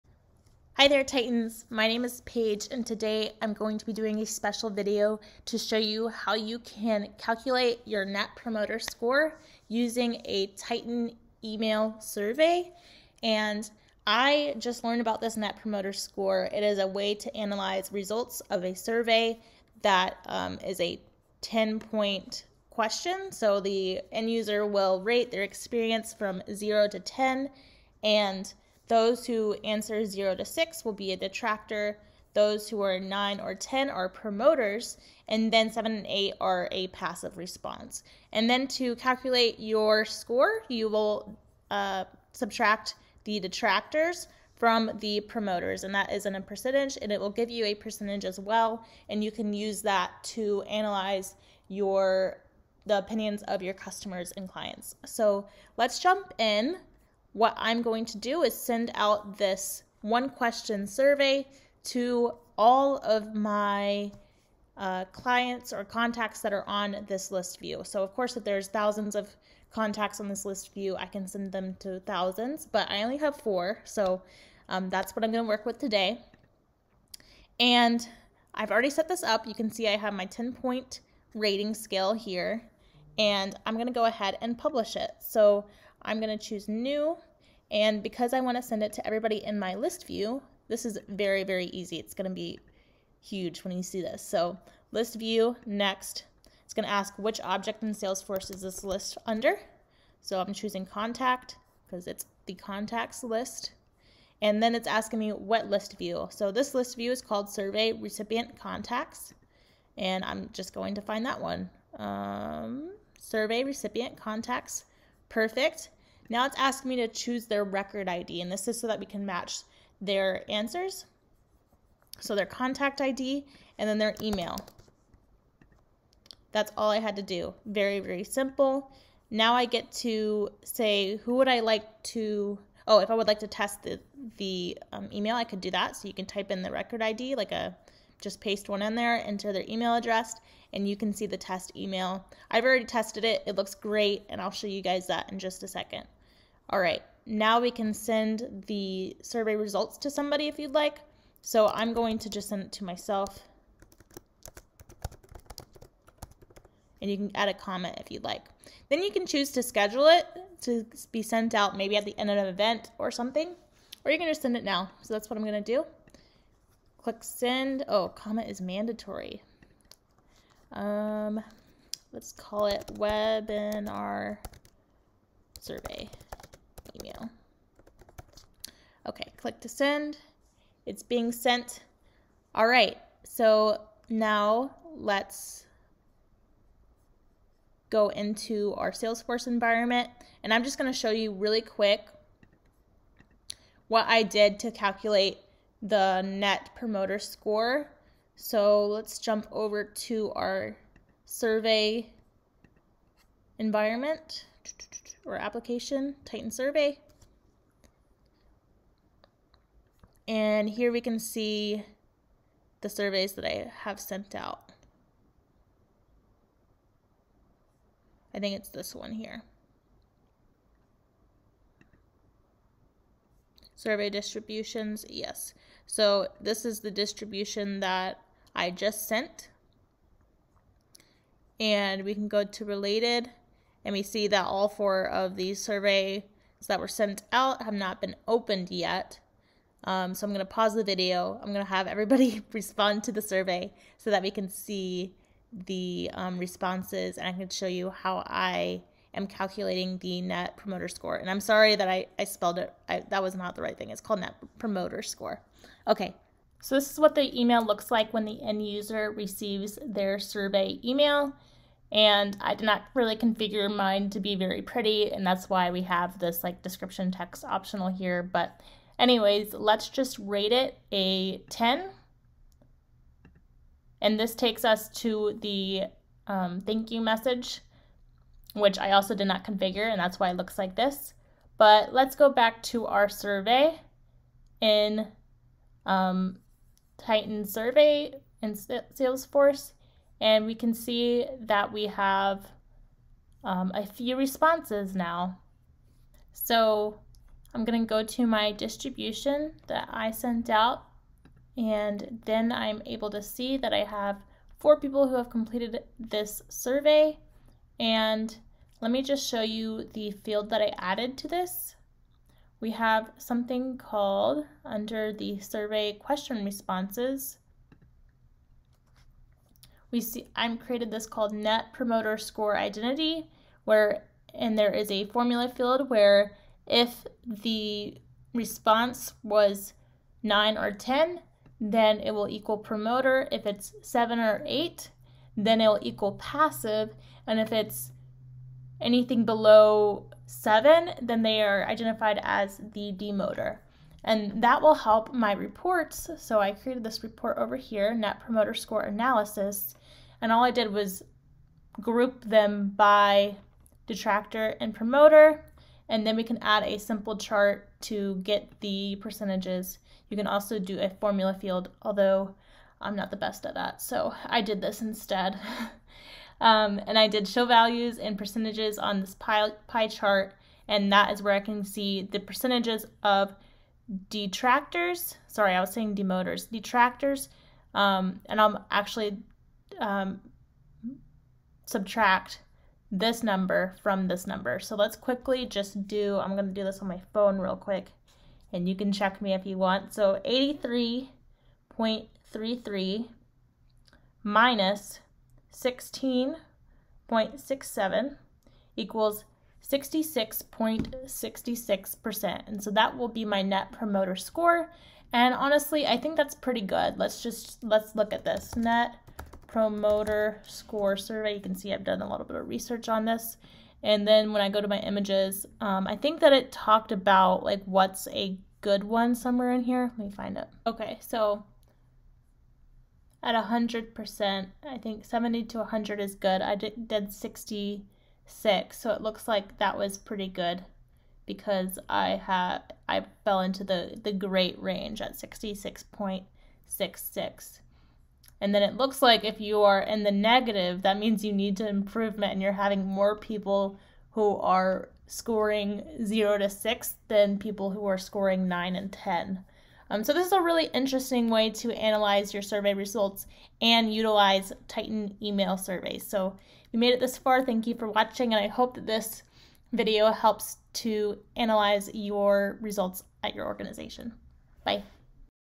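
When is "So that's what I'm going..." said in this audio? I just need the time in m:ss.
2:45.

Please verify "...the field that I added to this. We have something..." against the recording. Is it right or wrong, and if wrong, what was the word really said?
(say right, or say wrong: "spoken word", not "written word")
right.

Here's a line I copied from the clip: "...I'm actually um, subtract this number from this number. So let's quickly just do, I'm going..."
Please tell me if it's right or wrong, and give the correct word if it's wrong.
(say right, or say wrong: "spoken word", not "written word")
right.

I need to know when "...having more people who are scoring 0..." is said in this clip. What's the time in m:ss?
7:22.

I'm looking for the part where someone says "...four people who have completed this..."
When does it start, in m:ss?
5:04.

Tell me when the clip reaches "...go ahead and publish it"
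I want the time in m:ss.
1:23.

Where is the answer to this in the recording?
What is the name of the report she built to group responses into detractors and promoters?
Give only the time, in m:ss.
5:47.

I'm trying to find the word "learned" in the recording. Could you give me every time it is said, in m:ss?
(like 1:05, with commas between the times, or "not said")
0:14.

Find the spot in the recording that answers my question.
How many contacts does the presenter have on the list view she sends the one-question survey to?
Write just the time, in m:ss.
1:12.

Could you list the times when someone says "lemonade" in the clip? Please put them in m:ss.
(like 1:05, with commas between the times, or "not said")
not said.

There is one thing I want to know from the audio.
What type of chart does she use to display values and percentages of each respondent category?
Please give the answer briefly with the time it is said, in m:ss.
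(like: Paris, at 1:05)
Pie chart, at 6:09.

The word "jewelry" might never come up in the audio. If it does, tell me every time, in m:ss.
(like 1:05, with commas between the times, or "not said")
not said.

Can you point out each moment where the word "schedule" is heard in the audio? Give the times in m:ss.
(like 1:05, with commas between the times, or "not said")
2:39.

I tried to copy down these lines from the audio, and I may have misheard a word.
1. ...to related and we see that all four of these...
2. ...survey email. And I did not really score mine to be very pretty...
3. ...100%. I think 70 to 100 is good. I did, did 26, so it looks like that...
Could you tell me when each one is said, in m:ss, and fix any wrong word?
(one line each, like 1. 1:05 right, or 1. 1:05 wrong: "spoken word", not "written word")
1. 3:52 right
2. 4:20 wrong: "configure", not "score"
3. 7:03 wrong: "66", not "26".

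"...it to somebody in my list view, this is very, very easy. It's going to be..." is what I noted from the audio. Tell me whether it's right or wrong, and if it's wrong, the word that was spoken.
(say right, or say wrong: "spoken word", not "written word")
wrong: "everybody", not "somebody".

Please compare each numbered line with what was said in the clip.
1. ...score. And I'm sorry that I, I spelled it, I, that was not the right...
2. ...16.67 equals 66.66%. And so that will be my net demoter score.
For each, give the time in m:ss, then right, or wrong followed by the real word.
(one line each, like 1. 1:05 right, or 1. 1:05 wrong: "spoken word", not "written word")
1. 4:10 right
2. 6:35 wrong: "promoter", not "demoter".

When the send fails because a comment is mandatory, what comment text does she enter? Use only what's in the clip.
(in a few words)
Webinar survey email.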